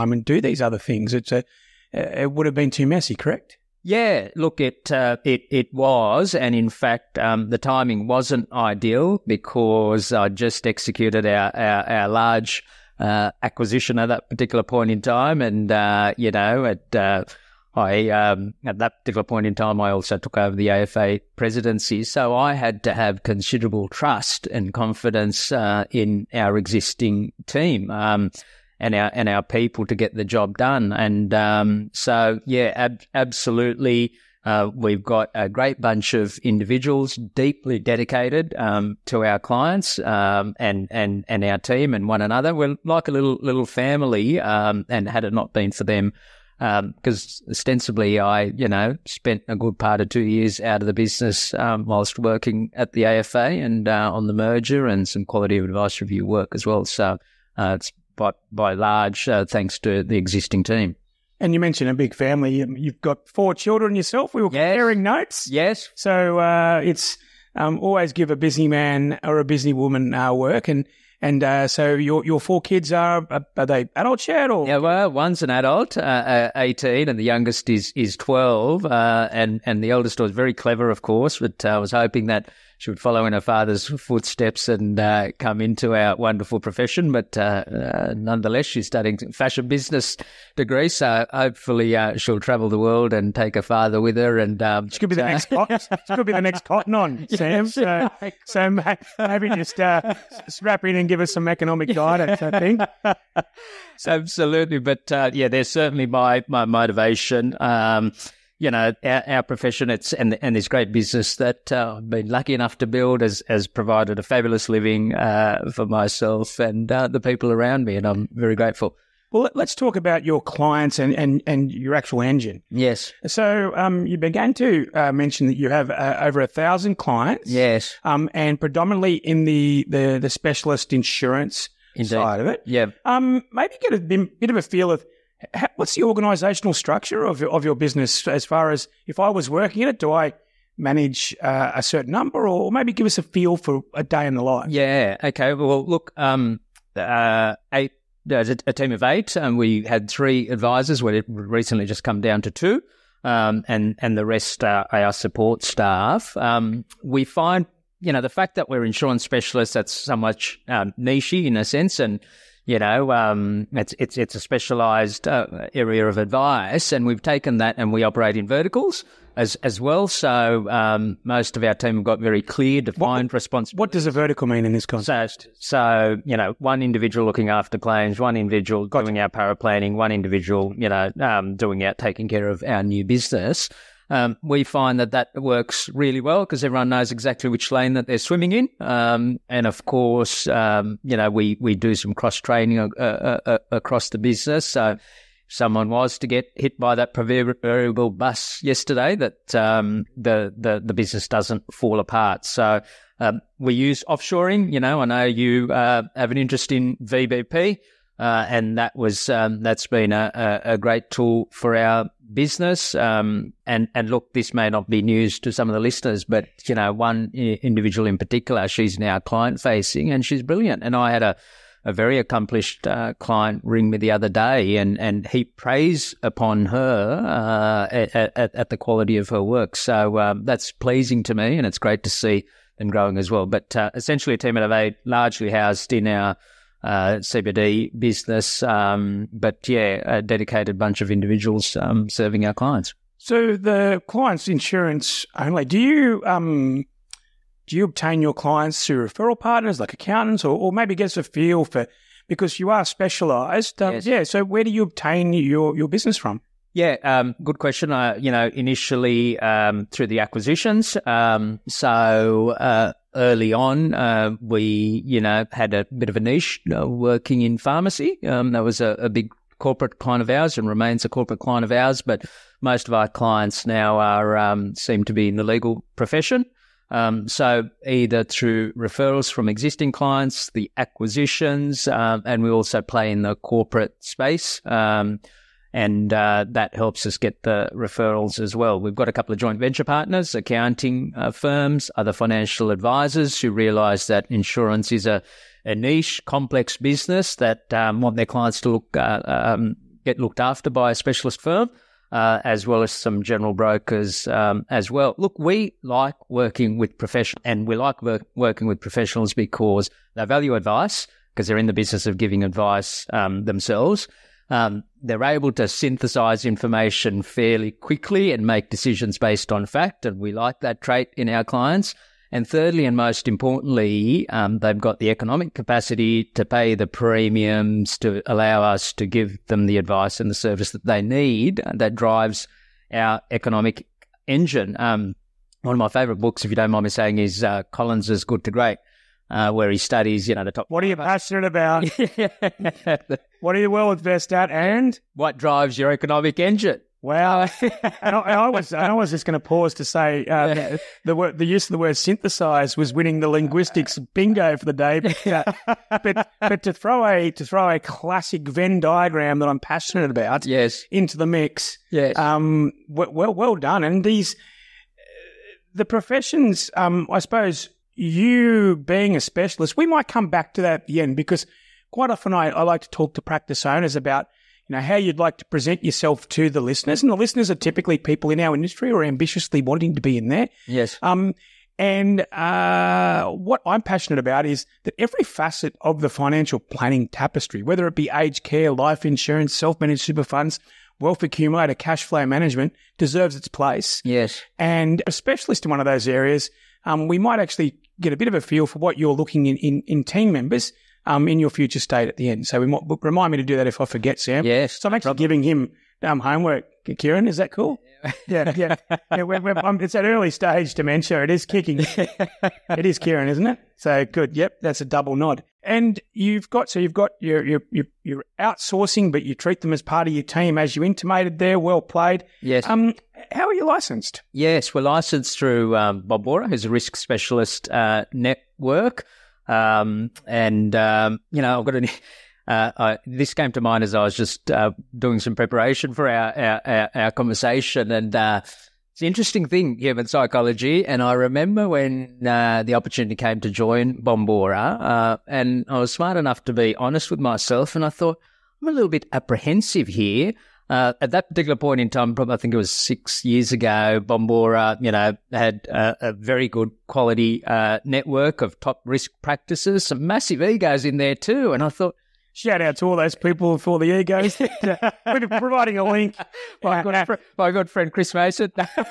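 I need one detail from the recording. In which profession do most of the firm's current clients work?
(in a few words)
Legal profession.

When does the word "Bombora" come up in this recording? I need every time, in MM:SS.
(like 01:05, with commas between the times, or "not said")
07:06, 07:24, 07:34.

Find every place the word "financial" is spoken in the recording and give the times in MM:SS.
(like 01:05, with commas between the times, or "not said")
04:52, 06:26.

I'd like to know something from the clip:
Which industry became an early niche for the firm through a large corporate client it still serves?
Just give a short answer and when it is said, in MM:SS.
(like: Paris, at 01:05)
Pharmacy, at 04:27.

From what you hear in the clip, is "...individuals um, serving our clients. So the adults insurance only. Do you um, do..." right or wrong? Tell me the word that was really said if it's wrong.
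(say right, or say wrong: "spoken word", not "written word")
wrong: "clients", not "adults".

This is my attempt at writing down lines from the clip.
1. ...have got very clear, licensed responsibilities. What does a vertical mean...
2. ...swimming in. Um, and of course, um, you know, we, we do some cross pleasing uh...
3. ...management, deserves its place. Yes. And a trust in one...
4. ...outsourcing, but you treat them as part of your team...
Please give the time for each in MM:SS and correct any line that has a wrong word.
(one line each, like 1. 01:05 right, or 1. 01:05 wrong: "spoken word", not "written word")
1. 02:51 wrong: "defined", not "licensed"
2. 03:08 wrong: "training", not "pleasing"
3. 06:32 wrong: "specialist", not "trust"
4. 06:58 right.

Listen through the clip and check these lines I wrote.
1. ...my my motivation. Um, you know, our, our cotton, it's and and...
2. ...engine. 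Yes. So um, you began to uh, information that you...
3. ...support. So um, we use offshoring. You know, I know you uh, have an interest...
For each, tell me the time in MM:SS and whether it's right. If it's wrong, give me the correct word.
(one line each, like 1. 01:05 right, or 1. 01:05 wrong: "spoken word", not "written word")
1. 01:46 wrong: "profession", not "cotton"
2. 02:02 wrong: "mention", not "information"
3. 03:21 wrong: "apart", not "support".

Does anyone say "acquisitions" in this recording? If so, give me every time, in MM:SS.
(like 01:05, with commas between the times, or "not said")
00:13, 04:20, 04:40.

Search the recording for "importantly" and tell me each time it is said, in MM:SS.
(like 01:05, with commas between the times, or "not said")
05:23.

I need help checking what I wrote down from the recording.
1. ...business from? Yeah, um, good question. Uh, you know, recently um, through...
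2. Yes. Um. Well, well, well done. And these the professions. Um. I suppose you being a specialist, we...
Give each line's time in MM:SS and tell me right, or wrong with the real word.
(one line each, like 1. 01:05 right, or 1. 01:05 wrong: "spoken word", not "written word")
1. 04:15 wrong: "initially", not "recently"
2. 06:01 right.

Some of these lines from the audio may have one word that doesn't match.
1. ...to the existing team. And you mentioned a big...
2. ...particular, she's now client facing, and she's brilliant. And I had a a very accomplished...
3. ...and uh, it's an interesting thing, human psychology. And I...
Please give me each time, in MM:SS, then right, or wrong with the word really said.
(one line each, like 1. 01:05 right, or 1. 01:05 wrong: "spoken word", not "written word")
1. 00:59 right
2. 03:38 right
3. 07:17 right.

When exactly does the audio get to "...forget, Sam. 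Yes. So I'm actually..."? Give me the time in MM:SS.
06:43.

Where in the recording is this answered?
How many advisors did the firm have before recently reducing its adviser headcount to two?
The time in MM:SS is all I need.
02:30.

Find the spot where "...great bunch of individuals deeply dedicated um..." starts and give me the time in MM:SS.
00:35.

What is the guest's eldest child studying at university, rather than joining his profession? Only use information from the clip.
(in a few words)
Fashion business.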